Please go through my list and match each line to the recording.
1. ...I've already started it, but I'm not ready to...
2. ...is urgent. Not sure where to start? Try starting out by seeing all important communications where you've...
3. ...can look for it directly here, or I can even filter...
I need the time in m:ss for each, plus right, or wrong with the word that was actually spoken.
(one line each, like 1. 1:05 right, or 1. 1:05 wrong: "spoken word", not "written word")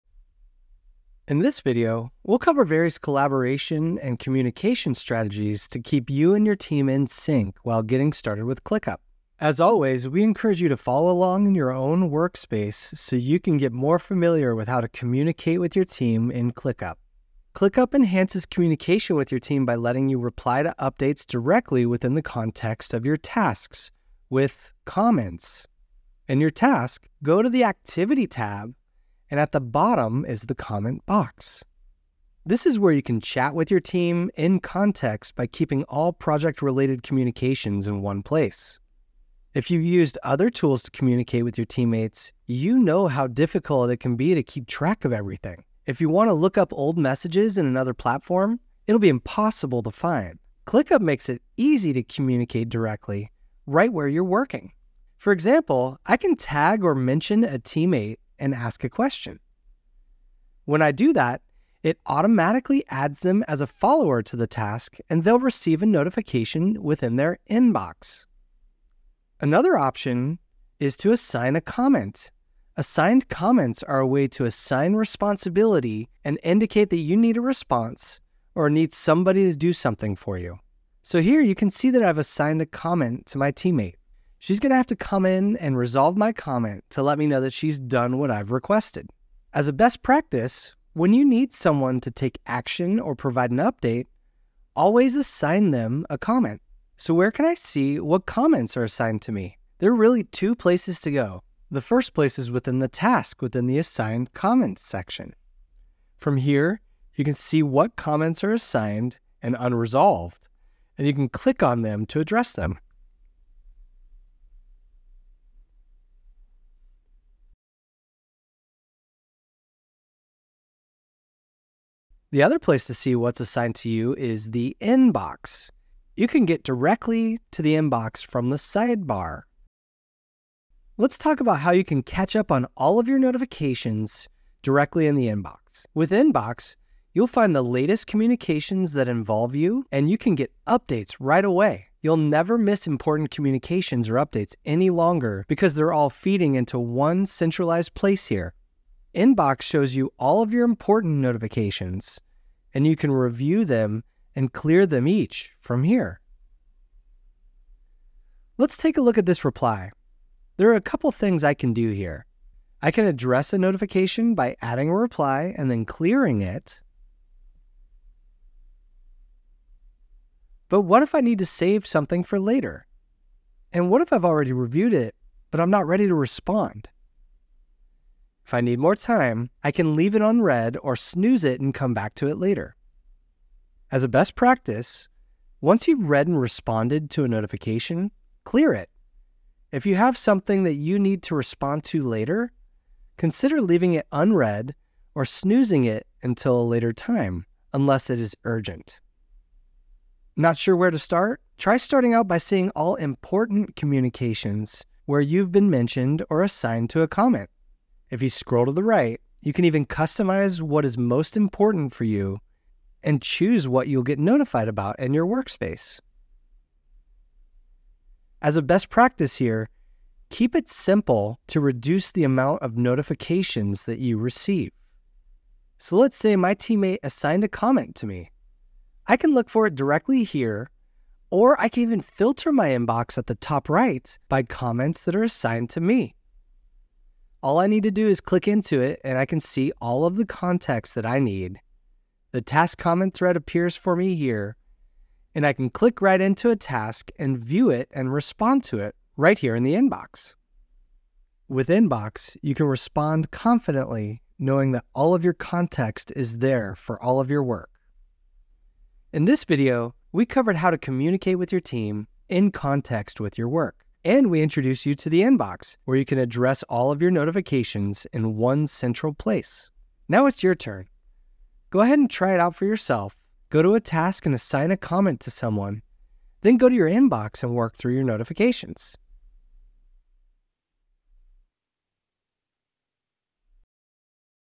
1. 2:54 wrong: "reviewed", not "started"
2. 3:18 right
3. 3:49 right.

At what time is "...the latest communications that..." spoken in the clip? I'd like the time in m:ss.
2:17.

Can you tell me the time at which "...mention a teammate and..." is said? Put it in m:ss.
0:56.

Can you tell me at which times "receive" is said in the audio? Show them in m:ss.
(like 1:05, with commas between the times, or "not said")
1:05, 3:44.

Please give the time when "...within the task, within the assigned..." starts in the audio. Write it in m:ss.
1:42.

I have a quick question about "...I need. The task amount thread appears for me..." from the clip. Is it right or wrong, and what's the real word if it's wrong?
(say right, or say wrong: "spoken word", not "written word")
wrong: "comment", not "amount".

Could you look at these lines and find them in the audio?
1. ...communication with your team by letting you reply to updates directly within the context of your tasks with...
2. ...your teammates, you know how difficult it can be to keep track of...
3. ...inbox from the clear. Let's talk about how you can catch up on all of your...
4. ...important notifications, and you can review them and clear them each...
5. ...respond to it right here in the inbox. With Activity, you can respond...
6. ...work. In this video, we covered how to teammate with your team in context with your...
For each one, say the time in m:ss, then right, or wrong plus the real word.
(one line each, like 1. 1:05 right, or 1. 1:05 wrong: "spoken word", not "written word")
1. 0:18 right
2. 0:41 right
3. 2:07 wrong: "sidebar", not "clear"
4. 2:30 right
5. 4:08 wrong: "Inbox", not "Activity"
6. 4:17 wrong: "communicate", not "teammate".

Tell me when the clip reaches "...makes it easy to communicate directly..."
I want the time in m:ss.
0:51.